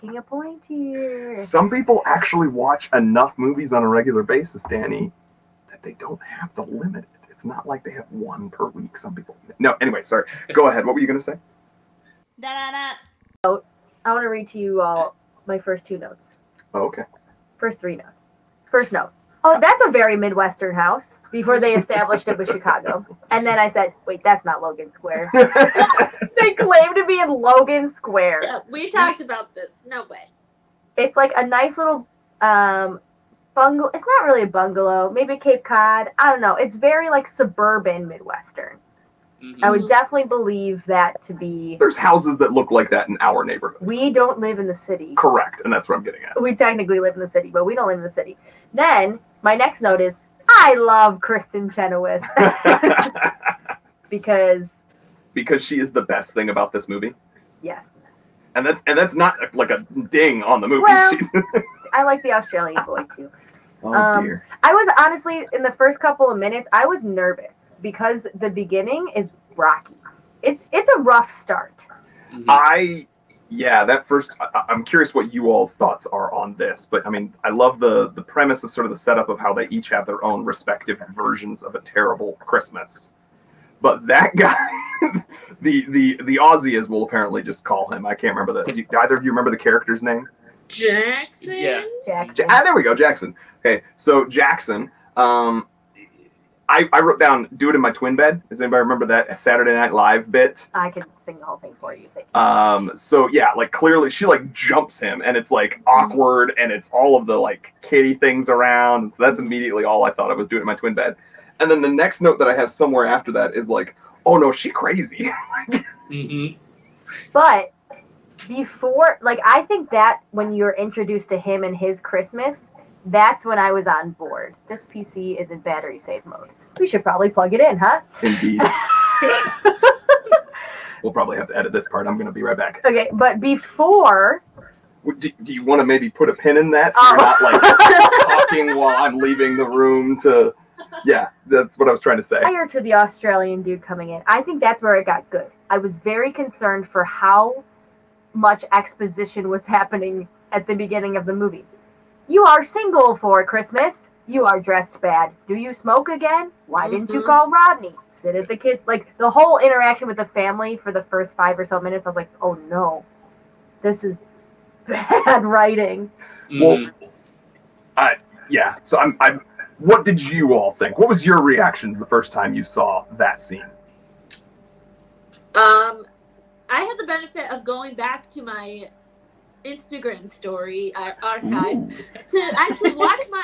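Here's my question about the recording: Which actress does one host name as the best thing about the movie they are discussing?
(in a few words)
Kristin Chenoweth.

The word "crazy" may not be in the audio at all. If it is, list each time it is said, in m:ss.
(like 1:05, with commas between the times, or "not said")
1:54.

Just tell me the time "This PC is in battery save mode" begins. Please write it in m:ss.
2:04.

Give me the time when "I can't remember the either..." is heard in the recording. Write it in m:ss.
1:28.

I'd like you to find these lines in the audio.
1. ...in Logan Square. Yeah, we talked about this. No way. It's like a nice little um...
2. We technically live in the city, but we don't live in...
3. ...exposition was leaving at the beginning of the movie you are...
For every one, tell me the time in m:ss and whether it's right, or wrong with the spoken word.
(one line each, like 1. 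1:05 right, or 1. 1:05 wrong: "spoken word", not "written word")
1. 0:27 right
2. 0:46 right
3. 2:28 wrong: "happening", not "leaving".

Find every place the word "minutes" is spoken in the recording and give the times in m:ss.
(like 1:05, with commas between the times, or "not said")
1:06, 2:41.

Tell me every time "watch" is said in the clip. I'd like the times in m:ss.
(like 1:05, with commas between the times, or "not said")
0:02, 3:02.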